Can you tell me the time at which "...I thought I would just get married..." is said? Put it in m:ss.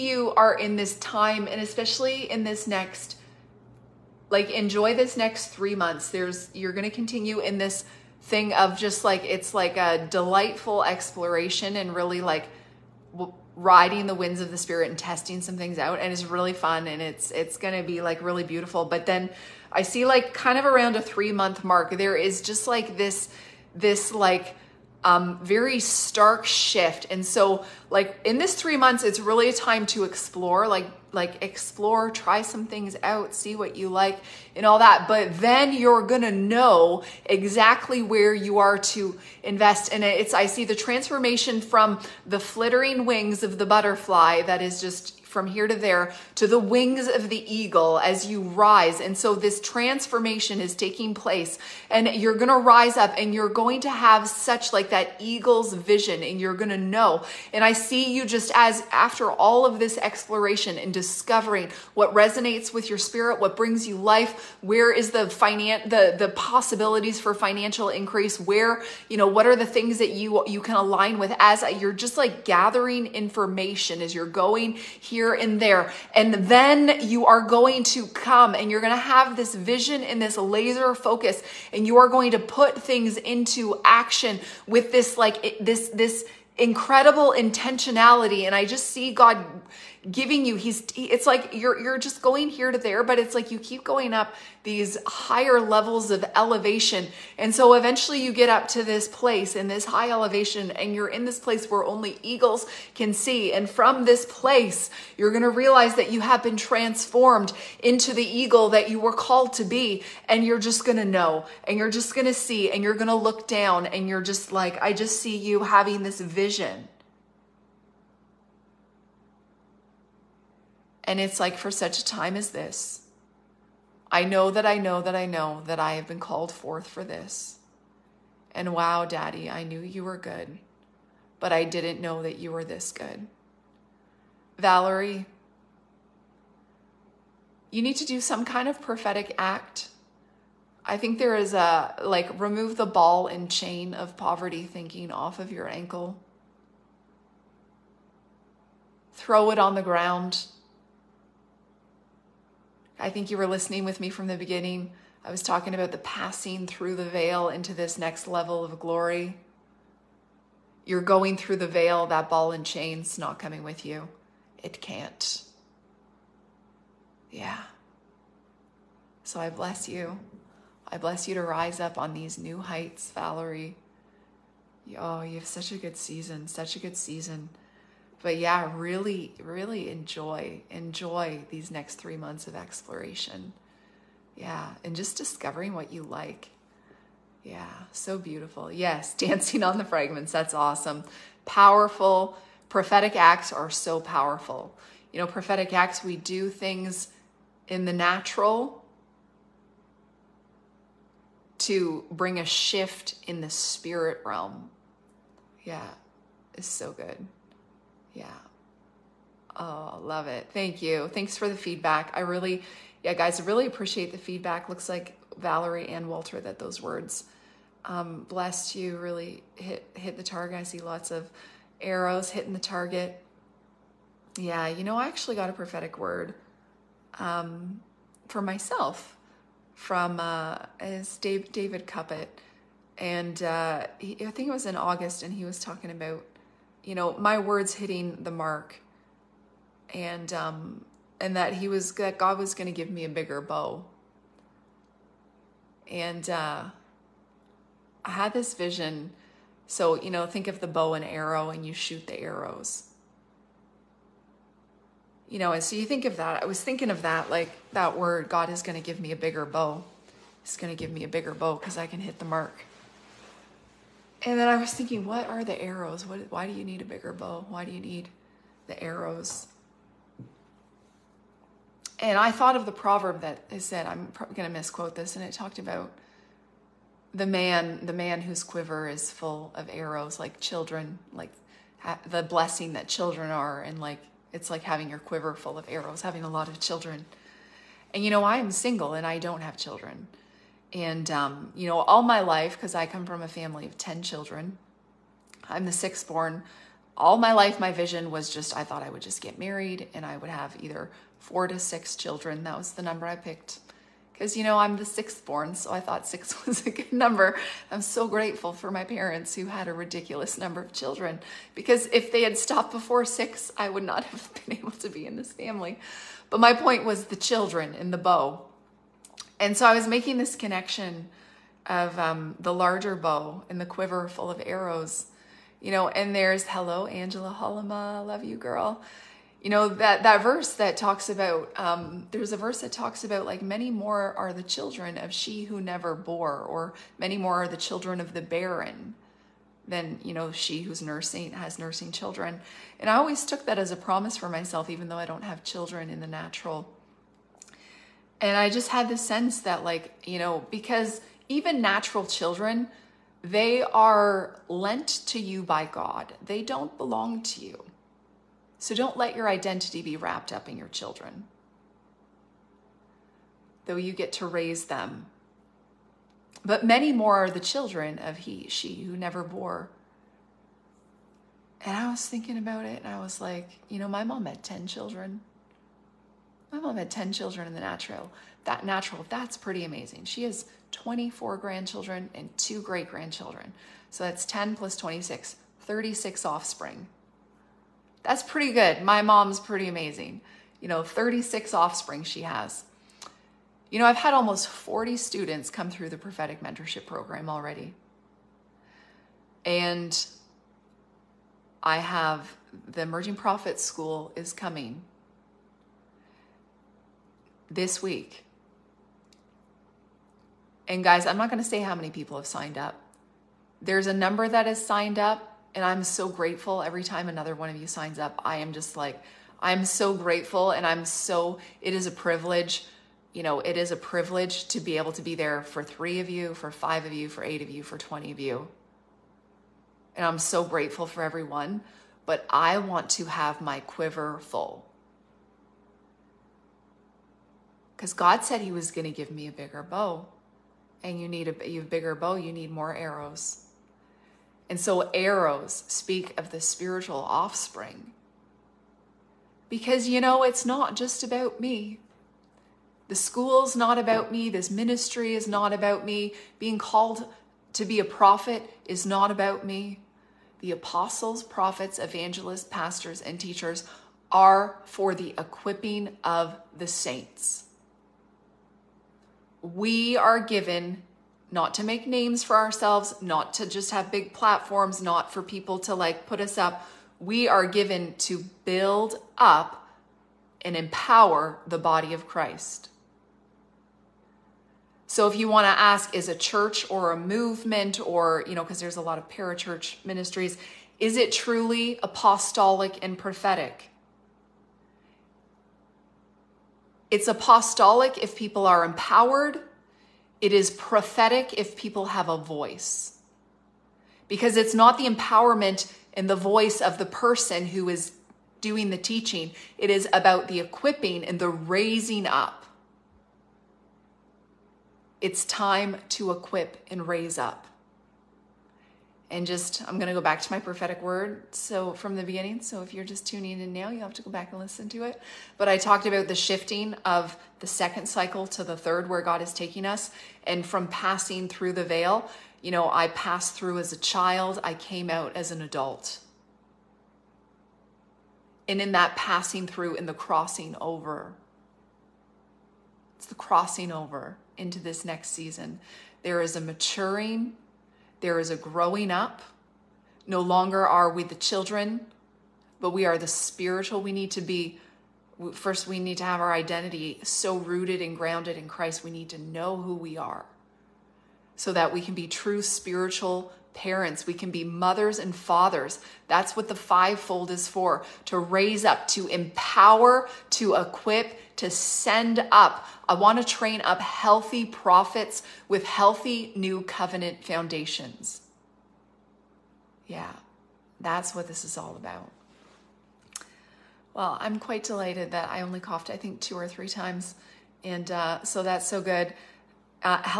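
4:58.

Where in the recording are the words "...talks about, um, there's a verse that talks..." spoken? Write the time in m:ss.
5:30.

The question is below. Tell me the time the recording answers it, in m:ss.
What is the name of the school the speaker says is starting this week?
6:42.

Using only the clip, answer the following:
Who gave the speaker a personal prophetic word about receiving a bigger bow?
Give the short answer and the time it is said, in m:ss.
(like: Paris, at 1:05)
David Cuppitt, at 3:51.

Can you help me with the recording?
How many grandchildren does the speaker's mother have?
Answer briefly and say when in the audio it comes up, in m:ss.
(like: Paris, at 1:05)
24, at 6:20.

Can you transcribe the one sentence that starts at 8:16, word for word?
It's apostolic if people are empowered.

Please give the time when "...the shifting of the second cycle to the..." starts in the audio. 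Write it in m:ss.
8:46.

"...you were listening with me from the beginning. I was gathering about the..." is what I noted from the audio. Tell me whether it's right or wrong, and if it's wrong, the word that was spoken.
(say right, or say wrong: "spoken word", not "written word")
wrong: "talking", not "gathering".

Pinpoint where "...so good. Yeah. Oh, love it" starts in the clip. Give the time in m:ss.
3:26.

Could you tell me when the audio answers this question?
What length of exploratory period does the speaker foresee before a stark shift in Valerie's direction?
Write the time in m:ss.
0:21.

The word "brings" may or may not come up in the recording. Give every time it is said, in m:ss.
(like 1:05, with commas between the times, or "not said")
1:03, 3:22.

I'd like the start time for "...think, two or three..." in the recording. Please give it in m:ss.
9:45.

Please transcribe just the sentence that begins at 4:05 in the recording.
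And uh I had this vision so, you know, think of the bow and arrow and you shoot the arrows.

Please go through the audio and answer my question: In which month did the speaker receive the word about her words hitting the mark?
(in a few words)
August.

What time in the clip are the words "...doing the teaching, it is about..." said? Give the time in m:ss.
8:28.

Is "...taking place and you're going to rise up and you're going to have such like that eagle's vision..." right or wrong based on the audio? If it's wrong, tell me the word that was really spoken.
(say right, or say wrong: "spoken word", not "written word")
right.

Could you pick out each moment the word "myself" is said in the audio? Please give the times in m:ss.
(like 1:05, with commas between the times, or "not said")
3:48, 5:44.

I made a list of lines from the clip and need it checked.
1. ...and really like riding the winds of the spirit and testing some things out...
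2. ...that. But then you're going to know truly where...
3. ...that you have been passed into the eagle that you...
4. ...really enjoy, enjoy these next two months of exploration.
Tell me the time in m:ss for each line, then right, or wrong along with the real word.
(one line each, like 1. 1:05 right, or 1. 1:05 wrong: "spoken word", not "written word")
1. 0:11 right
2. 0:34 wrong: "exactly", not "truly"
3. 1:45 wrong: "transformed", not "passed"
4. 2:59 wrong: "three", not "two".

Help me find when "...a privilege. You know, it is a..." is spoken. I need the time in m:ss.
7:01.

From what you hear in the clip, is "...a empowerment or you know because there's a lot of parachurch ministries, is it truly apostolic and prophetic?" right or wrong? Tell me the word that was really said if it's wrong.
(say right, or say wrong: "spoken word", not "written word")
wrong: "movement", not "empowerment".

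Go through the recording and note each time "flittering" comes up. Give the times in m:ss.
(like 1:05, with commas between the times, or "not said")
0:42.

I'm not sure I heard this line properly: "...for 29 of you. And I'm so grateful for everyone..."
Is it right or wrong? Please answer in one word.
wrong.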